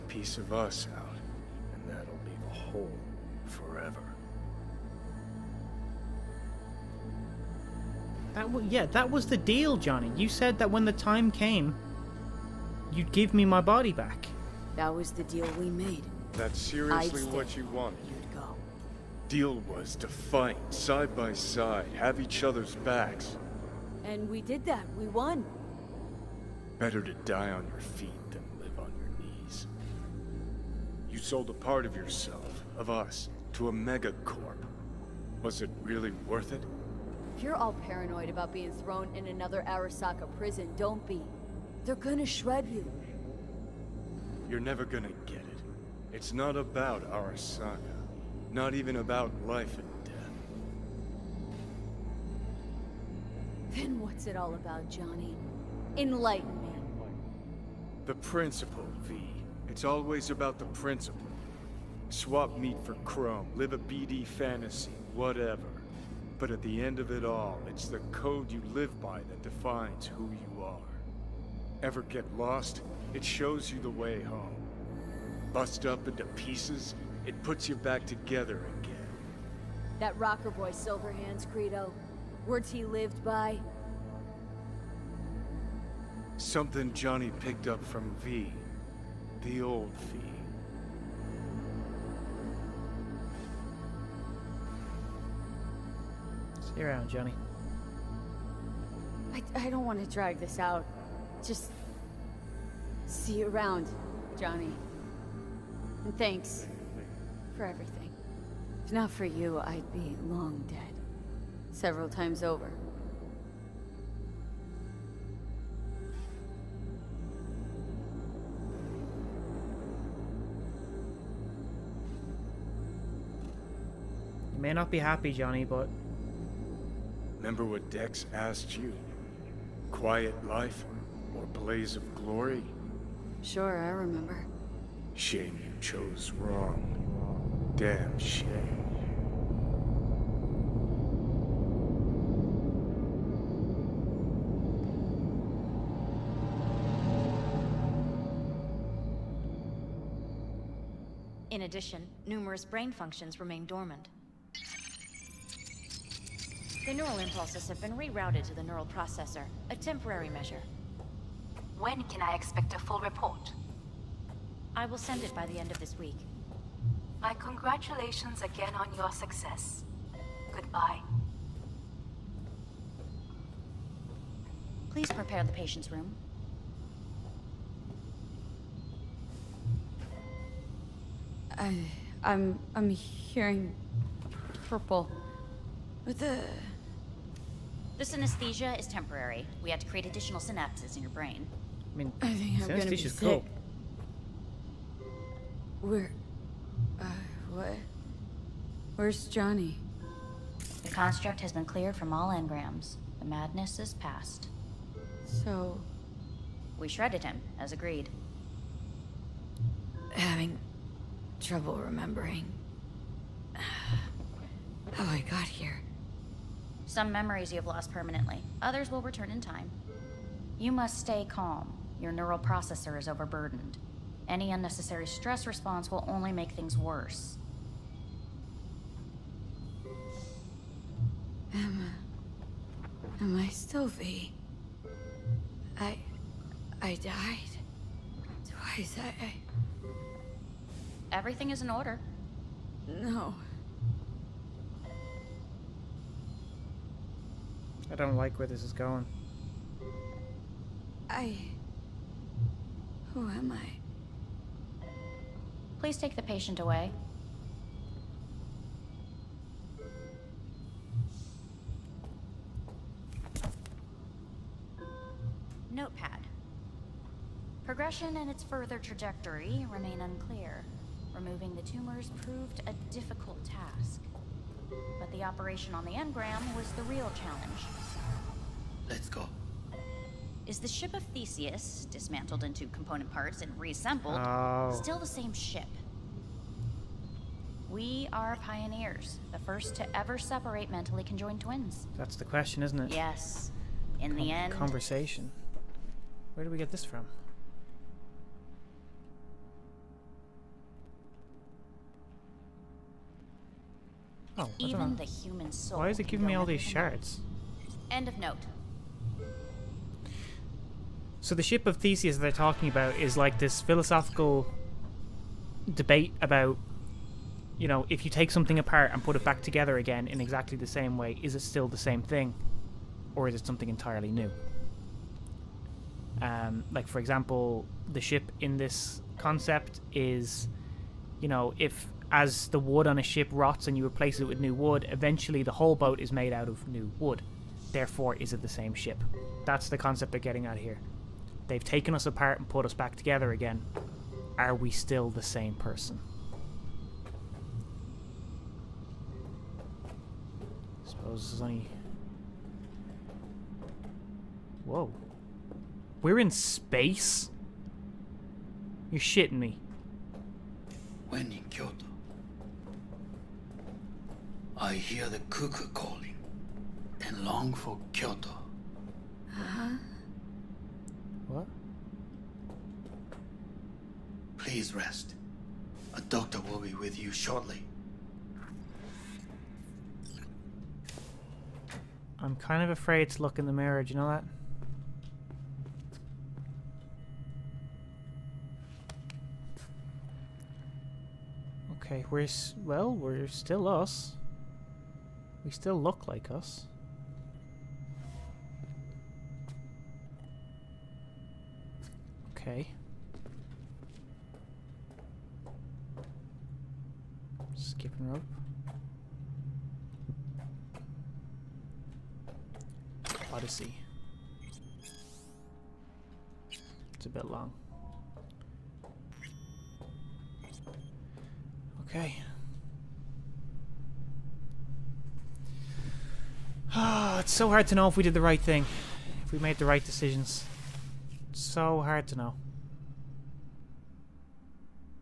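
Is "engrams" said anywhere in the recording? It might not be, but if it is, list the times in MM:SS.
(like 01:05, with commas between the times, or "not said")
03:22, 04:35.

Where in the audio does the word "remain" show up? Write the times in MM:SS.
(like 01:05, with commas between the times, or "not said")
02:33, 04:29.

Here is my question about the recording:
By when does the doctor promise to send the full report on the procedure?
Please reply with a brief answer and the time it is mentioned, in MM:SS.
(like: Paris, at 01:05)
end of this week, at 02:45.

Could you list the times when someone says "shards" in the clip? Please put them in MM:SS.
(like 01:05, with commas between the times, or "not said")
05:06.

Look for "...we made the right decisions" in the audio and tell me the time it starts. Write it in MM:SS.
07:09.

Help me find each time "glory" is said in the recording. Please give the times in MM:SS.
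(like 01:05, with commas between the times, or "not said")
02:12.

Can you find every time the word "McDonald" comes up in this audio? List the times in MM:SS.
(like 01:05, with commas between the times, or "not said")
not said.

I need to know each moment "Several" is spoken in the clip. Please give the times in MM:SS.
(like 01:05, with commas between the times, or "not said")
01:51.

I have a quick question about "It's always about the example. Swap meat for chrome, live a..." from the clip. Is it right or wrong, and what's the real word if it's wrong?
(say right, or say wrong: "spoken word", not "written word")
wrong: "principle", not "example".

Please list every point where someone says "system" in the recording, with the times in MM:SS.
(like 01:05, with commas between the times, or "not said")
not said.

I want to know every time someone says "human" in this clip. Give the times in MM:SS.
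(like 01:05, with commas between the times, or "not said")
05:05.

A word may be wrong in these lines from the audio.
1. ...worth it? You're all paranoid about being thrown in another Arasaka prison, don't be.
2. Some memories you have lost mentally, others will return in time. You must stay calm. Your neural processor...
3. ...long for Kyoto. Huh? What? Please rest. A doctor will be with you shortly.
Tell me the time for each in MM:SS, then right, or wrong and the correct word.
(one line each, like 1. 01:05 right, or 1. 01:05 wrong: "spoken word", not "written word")
1. 00:36 right
2. 03:36 wrong: "permanently", not "mentally"
3. 06:07 right.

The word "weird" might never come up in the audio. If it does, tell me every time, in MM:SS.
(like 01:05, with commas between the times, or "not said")
not said.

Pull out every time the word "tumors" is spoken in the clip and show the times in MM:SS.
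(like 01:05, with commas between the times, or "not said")
04:31.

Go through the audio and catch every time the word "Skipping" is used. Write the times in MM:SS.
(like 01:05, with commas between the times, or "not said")
06:47.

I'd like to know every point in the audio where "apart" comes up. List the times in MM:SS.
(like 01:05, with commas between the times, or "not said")
05:18, 05:42.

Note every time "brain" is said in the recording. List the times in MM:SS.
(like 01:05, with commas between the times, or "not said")
02:32, 03:11.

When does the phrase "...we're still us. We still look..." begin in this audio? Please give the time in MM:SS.
06:32.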